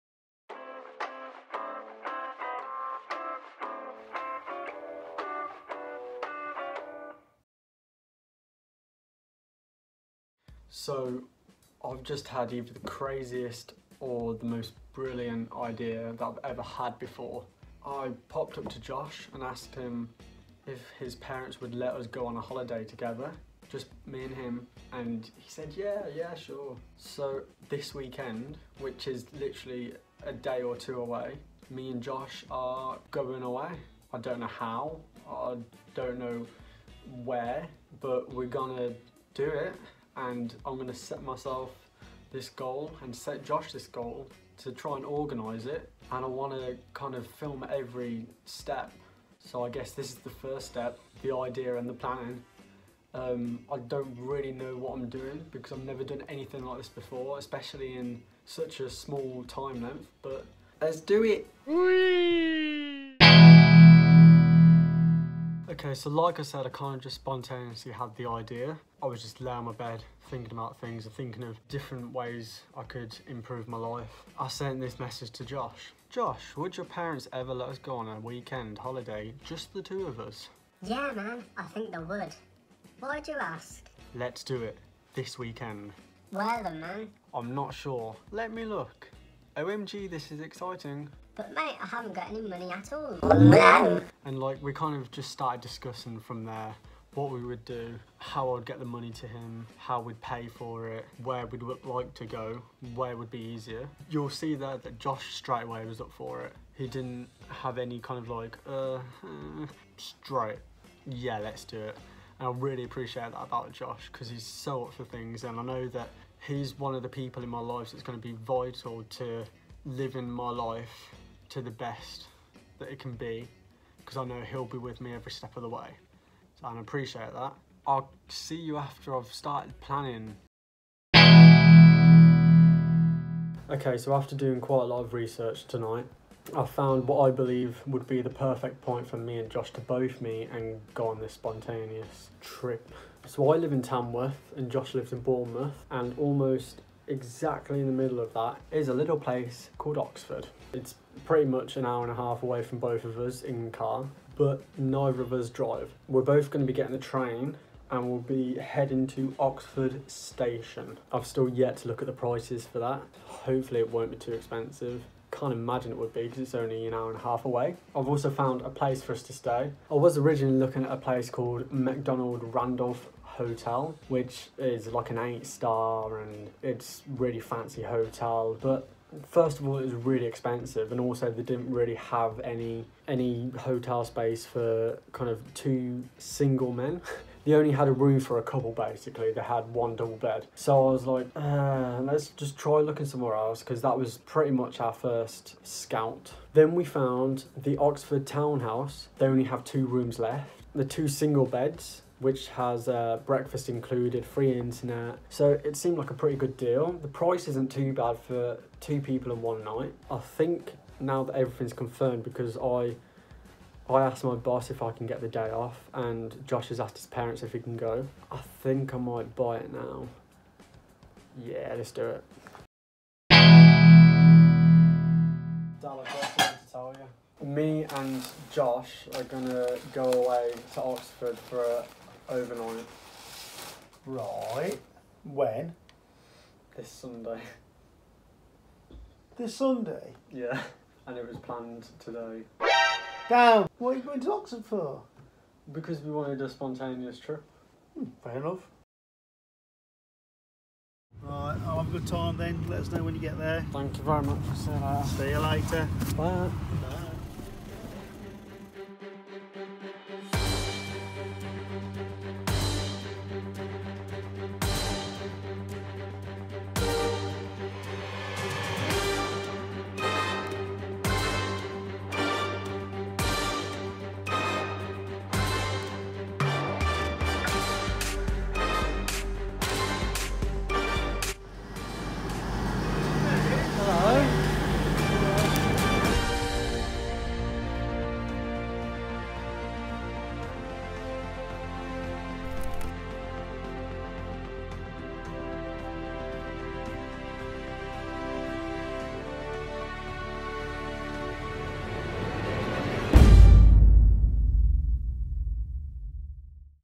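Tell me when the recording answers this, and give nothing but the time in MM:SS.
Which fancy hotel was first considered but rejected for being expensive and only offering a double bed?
02:51.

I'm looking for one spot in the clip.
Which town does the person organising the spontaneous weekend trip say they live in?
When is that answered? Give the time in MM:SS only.
02:23.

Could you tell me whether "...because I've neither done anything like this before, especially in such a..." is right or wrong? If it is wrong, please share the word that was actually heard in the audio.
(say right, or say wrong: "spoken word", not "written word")
wrong: "never", not "neither".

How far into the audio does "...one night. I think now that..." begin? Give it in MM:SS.
03:29.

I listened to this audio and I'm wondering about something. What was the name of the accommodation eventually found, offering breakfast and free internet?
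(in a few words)
Oxford Townhouse.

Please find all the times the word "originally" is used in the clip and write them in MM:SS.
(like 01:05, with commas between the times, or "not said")
02:50.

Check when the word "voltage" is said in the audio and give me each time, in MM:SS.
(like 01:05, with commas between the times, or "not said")
not said.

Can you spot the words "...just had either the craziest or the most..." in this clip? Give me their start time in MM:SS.
00:12.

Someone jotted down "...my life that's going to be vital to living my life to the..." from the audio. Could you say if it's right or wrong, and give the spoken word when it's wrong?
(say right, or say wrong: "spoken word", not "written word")
right.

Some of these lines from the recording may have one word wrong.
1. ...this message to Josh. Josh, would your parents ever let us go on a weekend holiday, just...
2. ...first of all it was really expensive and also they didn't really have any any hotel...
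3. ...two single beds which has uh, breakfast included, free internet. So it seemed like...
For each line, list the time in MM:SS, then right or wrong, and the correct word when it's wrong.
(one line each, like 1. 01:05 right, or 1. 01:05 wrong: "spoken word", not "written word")
1. 01:14 right
2. 02:59 right
3. 03:20 right.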